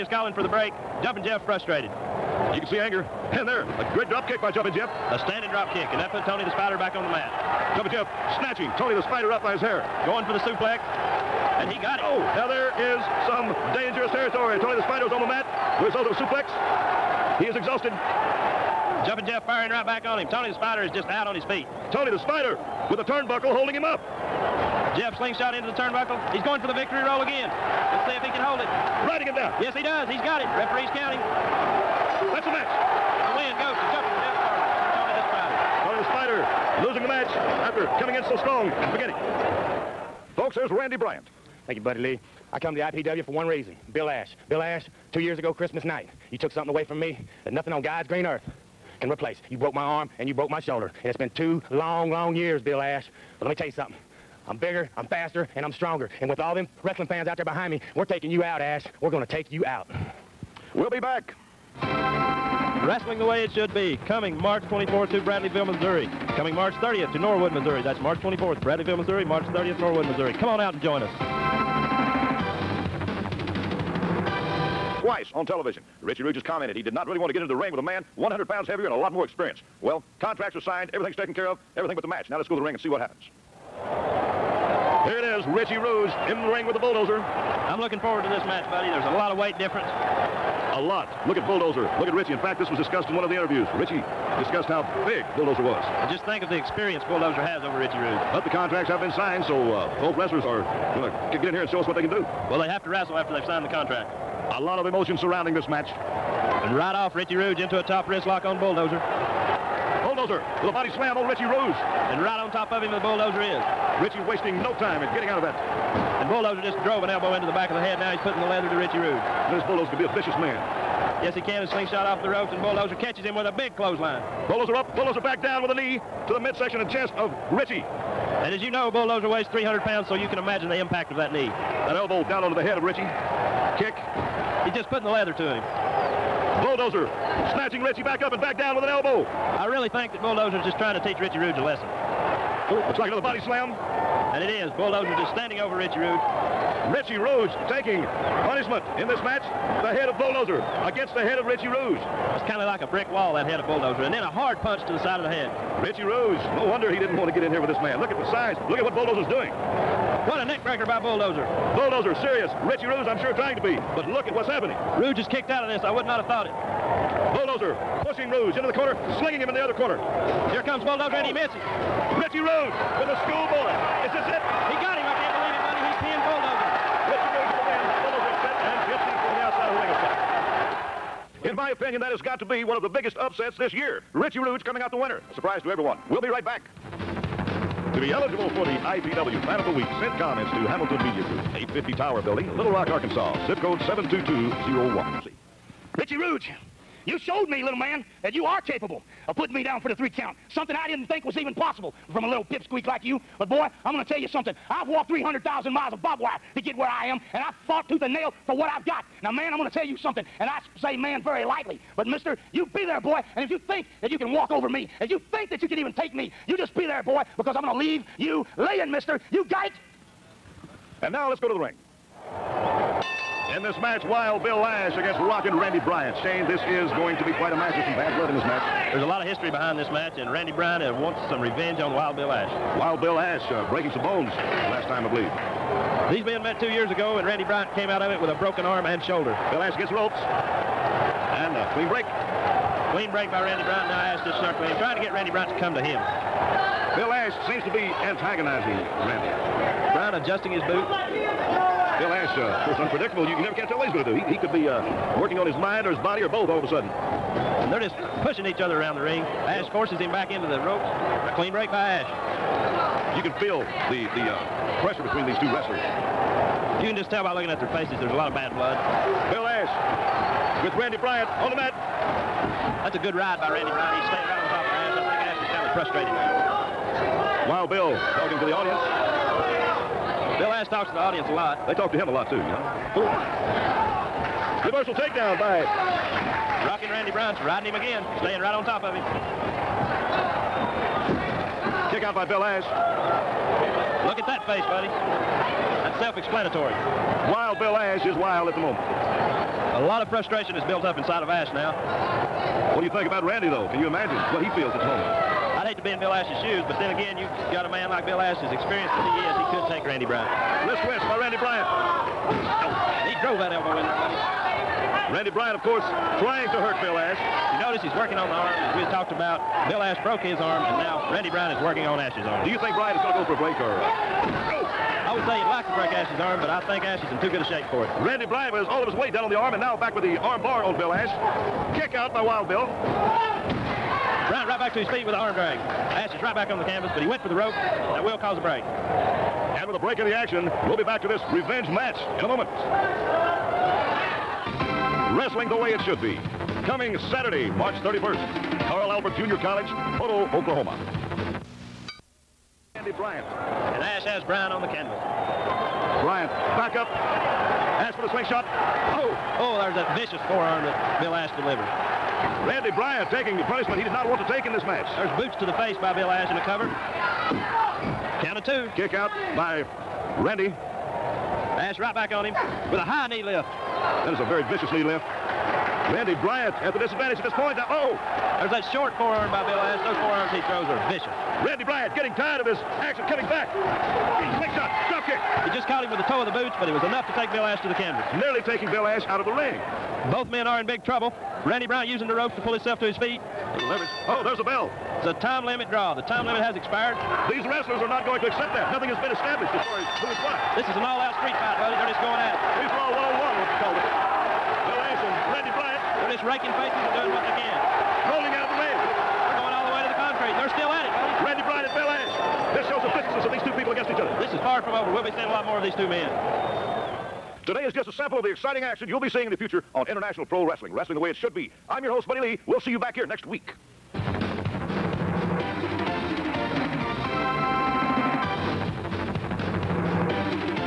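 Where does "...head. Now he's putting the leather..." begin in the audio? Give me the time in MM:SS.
01:57.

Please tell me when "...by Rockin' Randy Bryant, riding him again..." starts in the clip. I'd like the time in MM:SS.
04:45.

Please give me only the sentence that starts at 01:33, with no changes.
Richie discussed how big Bulldozer was.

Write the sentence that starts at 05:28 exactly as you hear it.
Randy Bly was all of his weight down on the arm, and now back with the arm bar, old Bill Ash.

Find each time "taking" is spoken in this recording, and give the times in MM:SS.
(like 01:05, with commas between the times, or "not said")
00:58, 02:27, 06:03, 06:28.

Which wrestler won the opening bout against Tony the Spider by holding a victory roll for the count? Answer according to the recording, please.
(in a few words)
Jumpin' Jeff Farmer.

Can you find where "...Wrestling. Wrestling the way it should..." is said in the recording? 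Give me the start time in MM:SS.
07:00.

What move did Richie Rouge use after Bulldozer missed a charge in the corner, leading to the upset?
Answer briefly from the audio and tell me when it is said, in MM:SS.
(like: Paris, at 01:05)
schoolboy, at 02:53.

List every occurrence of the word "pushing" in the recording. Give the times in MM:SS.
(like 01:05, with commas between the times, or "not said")
02:48, 04:18.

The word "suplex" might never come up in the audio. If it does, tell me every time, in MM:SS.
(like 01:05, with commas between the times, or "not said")
00:10, 00:16.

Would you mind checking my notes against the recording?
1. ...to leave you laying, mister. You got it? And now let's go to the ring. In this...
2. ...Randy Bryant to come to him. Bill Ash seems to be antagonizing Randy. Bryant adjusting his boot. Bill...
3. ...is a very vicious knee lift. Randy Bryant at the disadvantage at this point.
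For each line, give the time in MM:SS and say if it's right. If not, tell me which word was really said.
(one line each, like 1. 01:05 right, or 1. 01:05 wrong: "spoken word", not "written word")
1. 03:37 right
2. 04:05 right
3. 06:14 right.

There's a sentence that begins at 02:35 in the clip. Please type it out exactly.
Richie Rouge, no wonder he didn't want to get in here with this man.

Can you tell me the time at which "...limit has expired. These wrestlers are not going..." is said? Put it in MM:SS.
06:36.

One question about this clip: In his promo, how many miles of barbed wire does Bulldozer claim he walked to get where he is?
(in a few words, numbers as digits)
300,000.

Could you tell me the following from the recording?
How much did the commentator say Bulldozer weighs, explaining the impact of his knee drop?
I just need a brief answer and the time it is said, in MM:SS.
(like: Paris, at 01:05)
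300 pounds, at 02:09.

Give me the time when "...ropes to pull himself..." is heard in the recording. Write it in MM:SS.
06:32.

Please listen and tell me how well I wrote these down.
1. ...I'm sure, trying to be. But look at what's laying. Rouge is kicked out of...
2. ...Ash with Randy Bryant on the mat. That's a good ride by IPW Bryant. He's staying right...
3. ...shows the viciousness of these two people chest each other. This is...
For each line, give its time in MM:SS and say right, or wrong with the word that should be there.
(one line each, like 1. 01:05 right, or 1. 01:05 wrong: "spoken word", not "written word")
1. 02:43 wrong: "happening", not "laying"
2. 04:29 wrong: "Randy", not "IPW"
3. 06:52 wrong: "against", not "chest".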